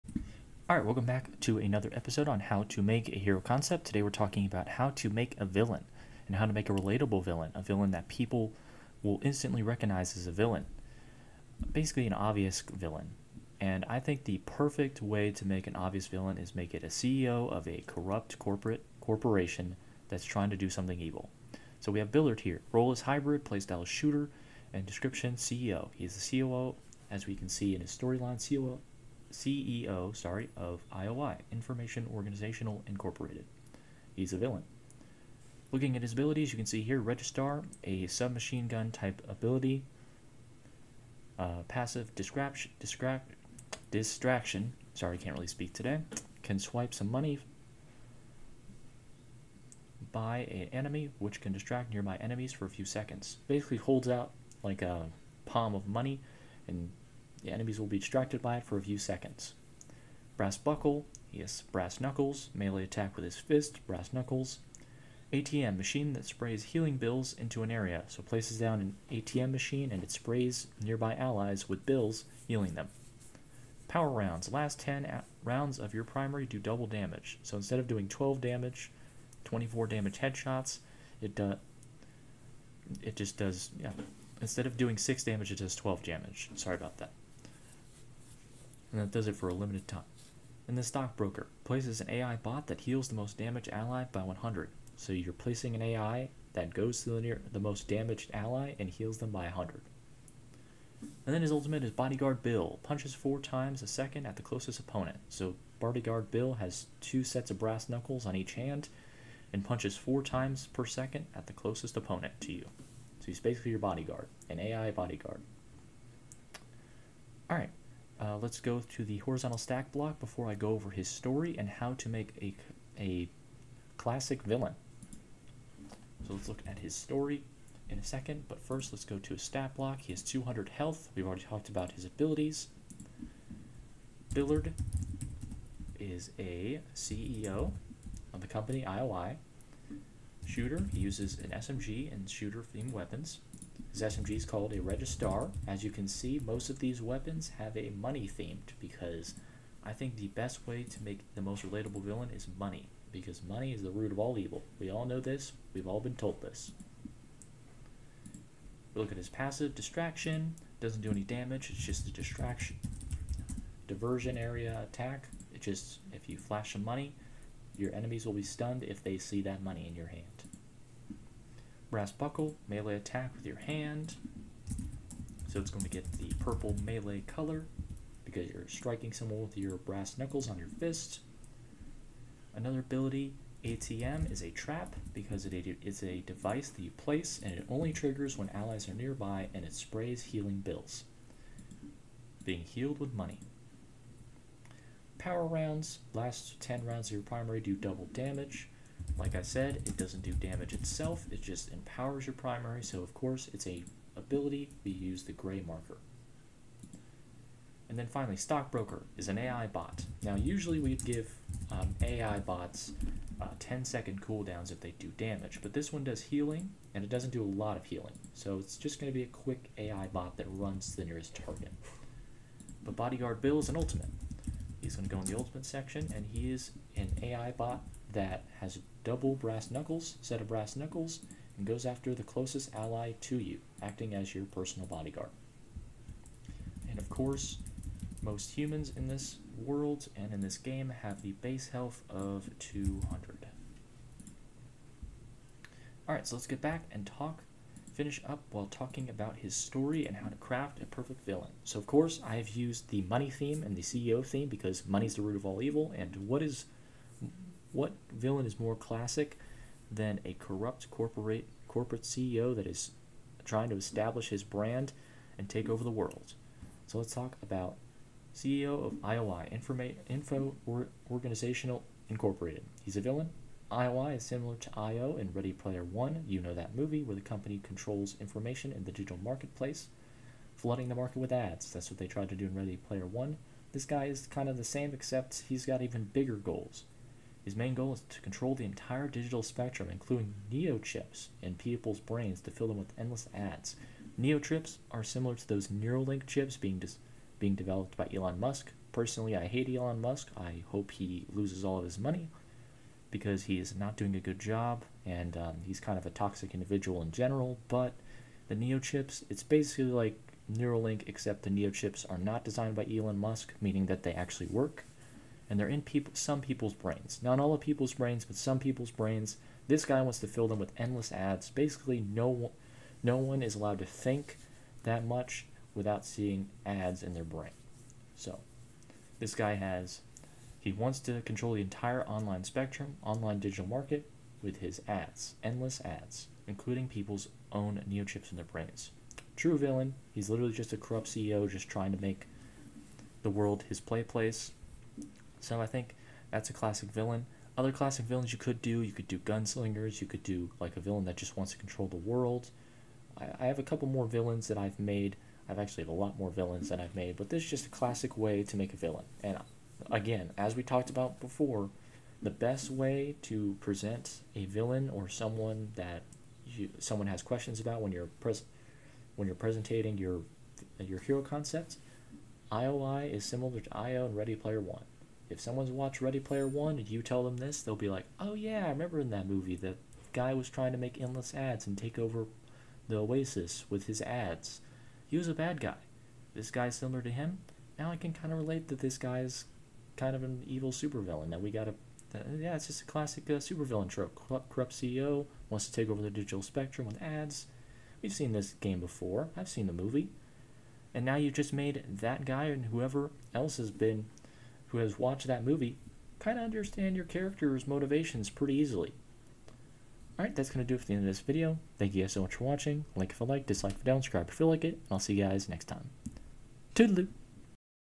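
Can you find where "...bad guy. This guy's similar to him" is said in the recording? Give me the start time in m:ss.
6:25.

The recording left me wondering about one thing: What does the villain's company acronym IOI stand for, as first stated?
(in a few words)
Information Organizational Incorporated.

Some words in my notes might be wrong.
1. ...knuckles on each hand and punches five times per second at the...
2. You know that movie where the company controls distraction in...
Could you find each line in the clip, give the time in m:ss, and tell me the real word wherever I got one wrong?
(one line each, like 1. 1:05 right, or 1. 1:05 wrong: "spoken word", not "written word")
1. 1:47 wrong: "four", not "five"
2. 4:36 wrong: "information", not "distraction".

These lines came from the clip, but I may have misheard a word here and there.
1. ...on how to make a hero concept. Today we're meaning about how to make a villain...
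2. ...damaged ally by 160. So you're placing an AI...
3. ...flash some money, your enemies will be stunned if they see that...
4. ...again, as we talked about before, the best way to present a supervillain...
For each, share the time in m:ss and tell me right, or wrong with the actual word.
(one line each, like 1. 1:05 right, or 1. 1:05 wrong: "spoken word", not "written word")
1. 0:02 wrong: "talking", not "meaning"
2. 1:33 wrong: "100", not "160"
3. 2:46 right
4. 5:59 wrong: "villain", not "supervillain".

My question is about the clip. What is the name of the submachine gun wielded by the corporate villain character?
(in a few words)
Registar.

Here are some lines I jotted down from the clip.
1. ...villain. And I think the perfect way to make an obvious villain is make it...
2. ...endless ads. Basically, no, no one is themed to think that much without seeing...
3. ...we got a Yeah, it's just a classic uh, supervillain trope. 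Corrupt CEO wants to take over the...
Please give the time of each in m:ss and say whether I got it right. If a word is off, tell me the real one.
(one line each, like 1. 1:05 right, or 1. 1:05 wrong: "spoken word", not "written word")
1. 0:12 right
2. 5:20 wrong: "allowed", not "themed"
3. 6:31 right.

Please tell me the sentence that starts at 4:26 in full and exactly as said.
So let's talk about CEO of IOI, Informa Info or Organizational Incorporated.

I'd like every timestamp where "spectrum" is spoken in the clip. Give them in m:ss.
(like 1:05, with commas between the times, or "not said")
4:49, 5:32, 6:36.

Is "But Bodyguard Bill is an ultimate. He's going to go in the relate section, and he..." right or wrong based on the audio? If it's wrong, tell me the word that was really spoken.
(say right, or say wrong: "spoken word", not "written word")
wrong: "ultimate", not "relate".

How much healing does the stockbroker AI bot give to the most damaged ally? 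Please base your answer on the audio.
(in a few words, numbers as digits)
100.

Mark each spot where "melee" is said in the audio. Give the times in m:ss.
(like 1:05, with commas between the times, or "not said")
1:02, 2:52, 2:56.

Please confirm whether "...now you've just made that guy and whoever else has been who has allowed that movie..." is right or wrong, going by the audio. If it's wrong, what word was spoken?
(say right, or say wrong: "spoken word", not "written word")
wrong: "watched", not "allowed".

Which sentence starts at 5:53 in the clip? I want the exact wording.
I, I have a couple more villains that I've made.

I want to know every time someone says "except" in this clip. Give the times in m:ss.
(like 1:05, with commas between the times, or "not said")
4:44, 5:11.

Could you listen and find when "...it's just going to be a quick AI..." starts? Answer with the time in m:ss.
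3:38.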